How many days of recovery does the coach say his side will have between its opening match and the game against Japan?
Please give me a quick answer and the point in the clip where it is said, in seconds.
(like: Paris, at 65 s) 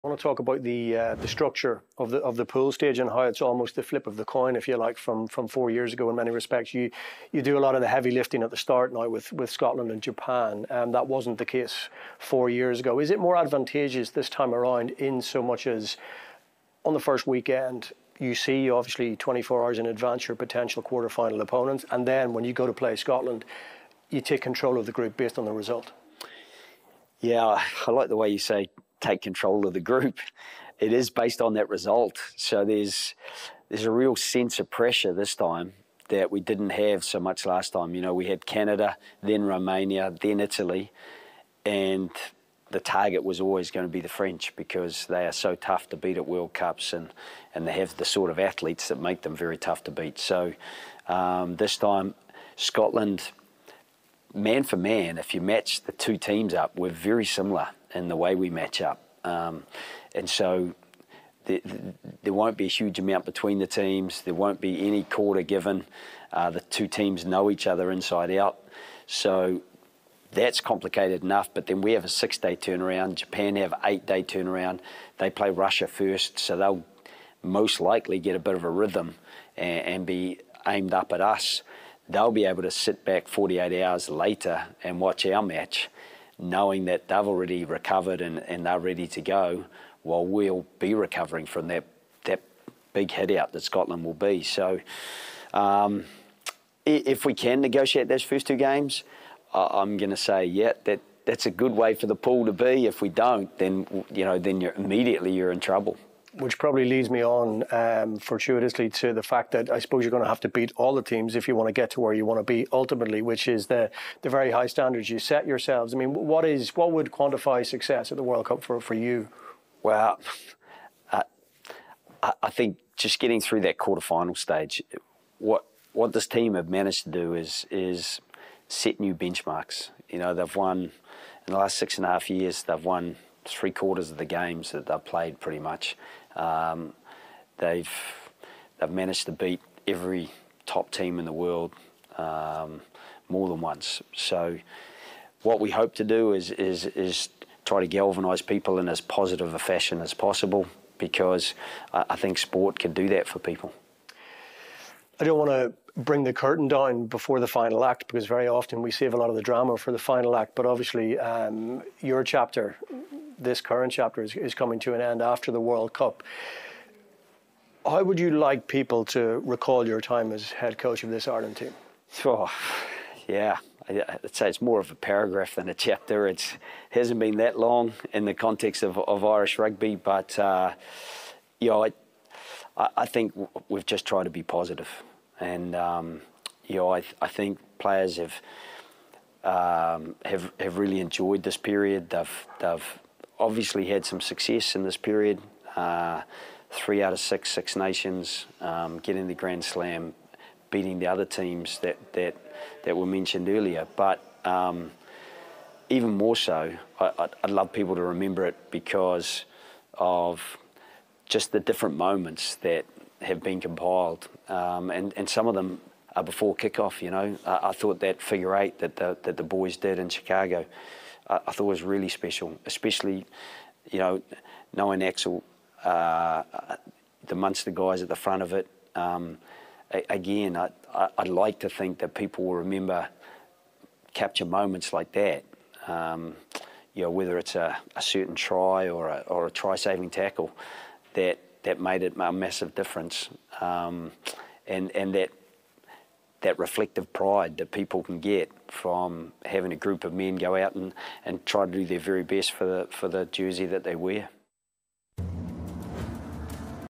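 6, at 72 s.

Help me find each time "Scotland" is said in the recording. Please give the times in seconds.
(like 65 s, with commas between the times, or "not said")
9 s, 22 s, 52 s, 93 s.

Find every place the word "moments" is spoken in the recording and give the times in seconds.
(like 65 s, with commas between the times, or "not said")
211 s, 234 s.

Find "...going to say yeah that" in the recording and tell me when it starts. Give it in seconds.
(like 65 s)
99 s.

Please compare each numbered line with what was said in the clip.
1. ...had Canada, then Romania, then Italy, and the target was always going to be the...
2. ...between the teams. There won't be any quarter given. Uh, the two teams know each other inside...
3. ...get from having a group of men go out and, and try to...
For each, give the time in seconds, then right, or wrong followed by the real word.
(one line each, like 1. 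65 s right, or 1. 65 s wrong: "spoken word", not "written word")
1. 38 s right
2. 63 s right
3. 248 s right.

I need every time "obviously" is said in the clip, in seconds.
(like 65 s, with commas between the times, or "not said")
18 s, 160 s, 193 s.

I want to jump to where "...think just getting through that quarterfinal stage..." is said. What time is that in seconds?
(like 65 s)
122 s.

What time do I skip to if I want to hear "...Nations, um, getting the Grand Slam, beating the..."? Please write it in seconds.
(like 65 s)
197 s.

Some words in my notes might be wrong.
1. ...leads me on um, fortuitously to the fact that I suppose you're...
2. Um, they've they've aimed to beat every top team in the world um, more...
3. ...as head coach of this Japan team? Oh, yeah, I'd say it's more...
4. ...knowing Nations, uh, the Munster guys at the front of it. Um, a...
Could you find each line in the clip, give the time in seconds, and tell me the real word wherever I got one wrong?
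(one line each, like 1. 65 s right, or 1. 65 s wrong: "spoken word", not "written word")
1. 106 s right
2. 136 s wrong: "managed", not "aimed"
3. 170 s wrong: "Ireland", not "Japan"
4. 224 s wrong: "Axel", not "Nations".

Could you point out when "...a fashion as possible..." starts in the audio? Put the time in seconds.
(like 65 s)
149 s.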